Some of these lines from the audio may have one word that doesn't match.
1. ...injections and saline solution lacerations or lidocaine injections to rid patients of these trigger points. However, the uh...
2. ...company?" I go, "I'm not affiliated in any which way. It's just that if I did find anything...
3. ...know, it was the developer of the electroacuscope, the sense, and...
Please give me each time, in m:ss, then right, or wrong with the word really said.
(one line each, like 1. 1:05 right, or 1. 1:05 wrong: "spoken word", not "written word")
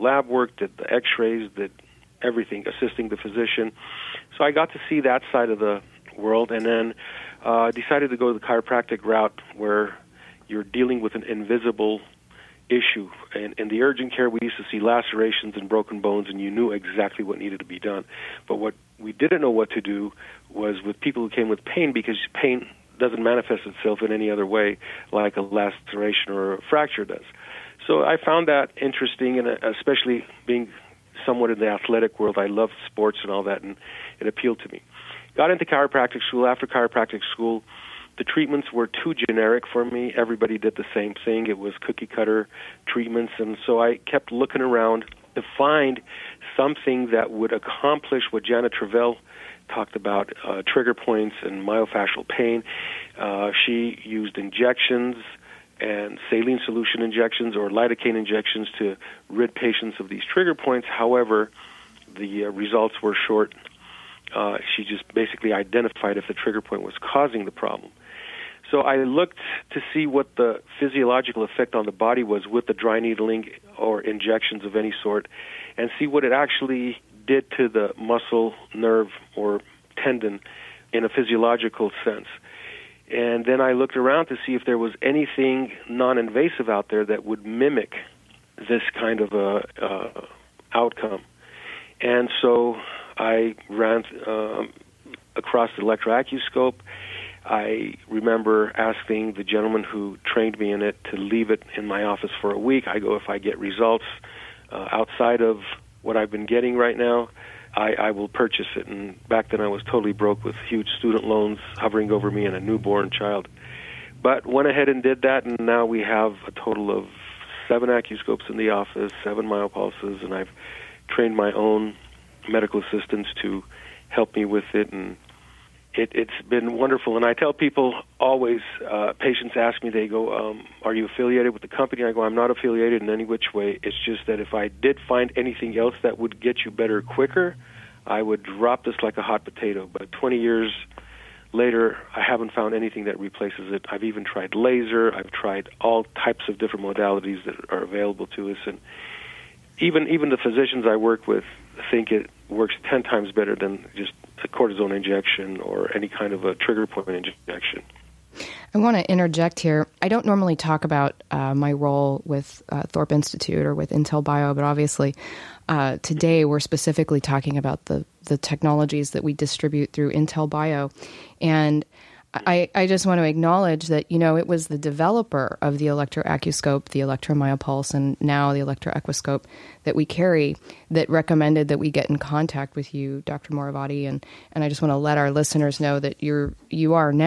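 1. 0:54 wrong: "injections", not "lacerations"
2. 2:11 right
3. 2:54 wrong: "electromyopulse", not "sense".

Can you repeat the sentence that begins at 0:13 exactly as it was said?
And in the urgent care, we used to see lacerations and broken bones, and you knew exactly what needed to be done.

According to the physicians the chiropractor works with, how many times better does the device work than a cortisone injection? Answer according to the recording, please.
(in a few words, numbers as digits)
10 times.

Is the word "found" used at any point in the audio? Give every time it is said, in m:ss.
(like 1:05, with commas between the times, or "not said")
0:28, 2:22.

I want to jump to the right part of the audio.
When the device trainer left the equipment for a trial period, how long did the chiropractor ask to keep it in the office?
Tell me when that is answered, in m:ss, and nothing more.
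1:42.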